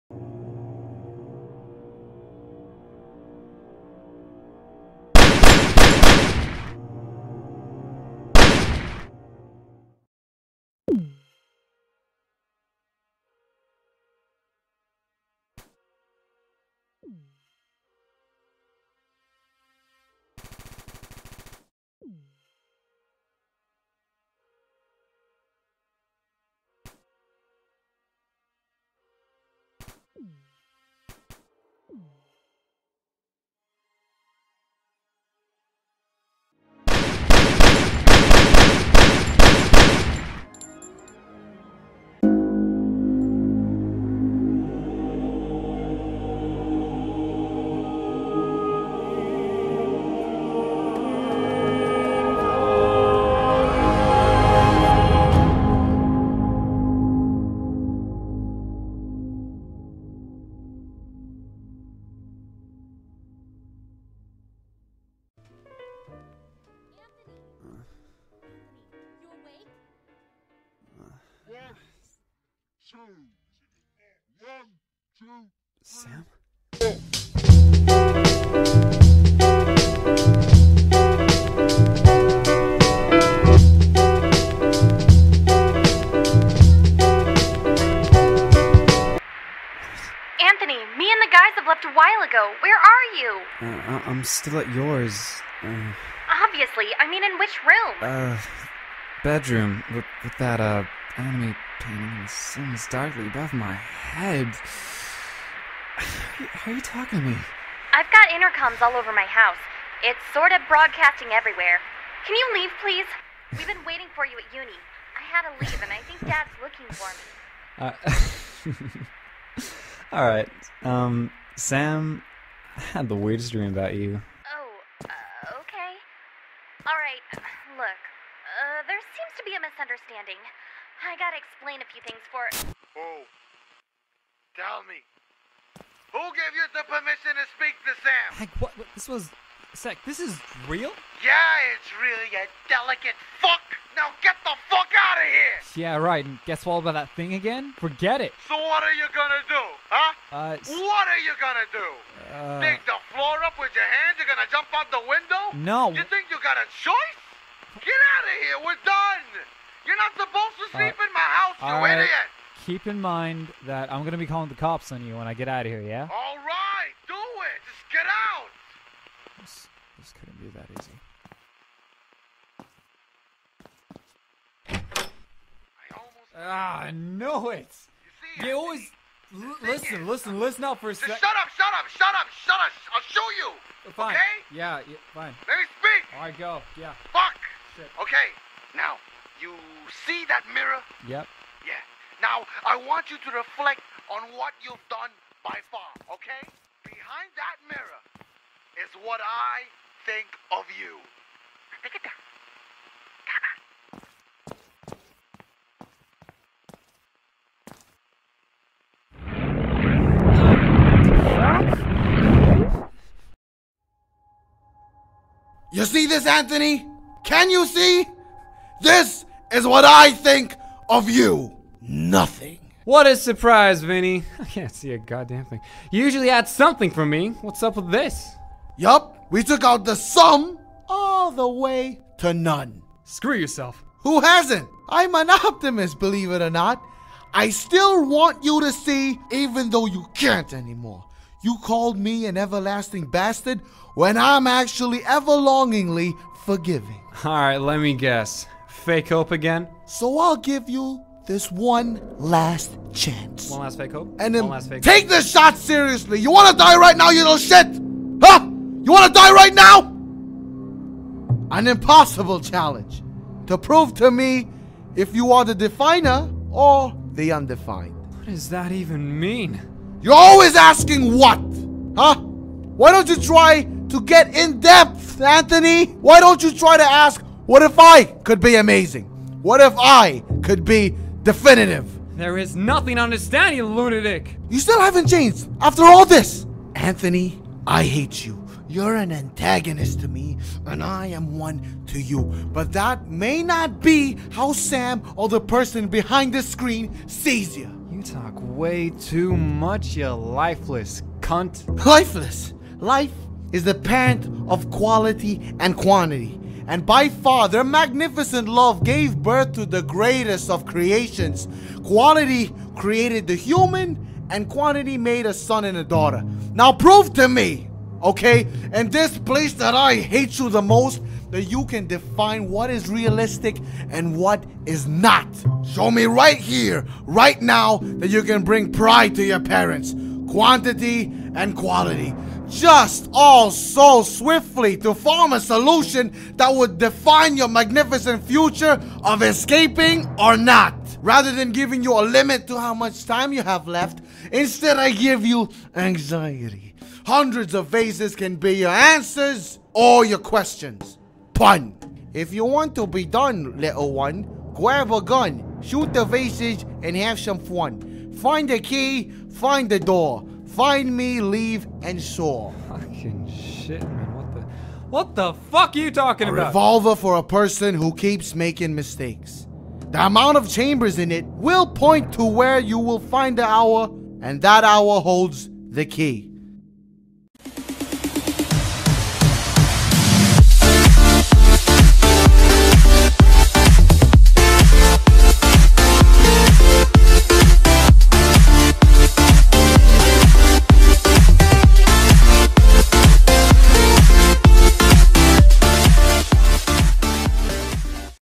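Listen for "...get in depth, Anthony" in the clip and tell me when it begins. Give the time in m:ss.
4:34.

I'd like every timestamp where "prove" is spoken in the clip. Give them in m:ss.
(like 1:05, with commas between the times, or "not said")
4:23, 5:16.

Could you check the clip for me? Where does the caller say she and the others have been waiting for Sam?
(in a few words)
uni.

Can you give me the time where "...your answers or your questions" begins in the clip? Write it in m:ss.
5:48.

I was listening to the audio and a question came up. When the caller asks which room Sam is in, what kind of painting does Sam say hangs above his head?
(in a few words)
anime painting.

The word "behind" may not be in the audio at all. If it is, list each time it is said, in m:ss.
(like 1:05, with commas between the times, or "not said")
3:16, 4:55.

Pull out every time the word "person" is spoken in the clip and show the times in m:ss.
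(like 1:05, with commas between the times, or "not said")
4:55, 6:07.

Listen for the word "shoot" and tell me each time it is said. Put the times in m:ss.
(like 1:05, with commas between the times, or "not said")
5:55.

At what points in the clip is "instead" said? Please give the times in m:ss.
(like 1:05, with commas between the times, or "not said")
5:44.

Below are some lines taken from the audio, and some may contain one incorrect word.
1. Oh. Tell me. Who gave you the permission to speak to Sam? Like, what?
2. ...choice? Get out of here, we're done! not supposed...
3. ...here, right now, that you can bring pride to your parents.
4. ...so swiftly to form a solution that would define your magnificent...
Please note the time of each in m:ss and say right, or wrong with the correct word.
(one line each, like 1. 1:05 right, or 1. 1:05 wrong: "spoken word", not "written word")
1. 2:12 right
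2. 2:36 right
3. 5:26 right
4. 5:33 right.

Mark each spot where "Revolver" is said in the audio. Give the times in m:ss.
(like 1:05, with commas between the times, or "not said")
6:06.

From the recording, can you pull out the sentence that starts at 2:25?
Yeah, right, and guess what about that thing again?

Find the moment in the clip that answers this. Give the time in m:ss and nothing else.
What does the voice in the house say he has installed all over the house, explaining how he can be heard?
1:48.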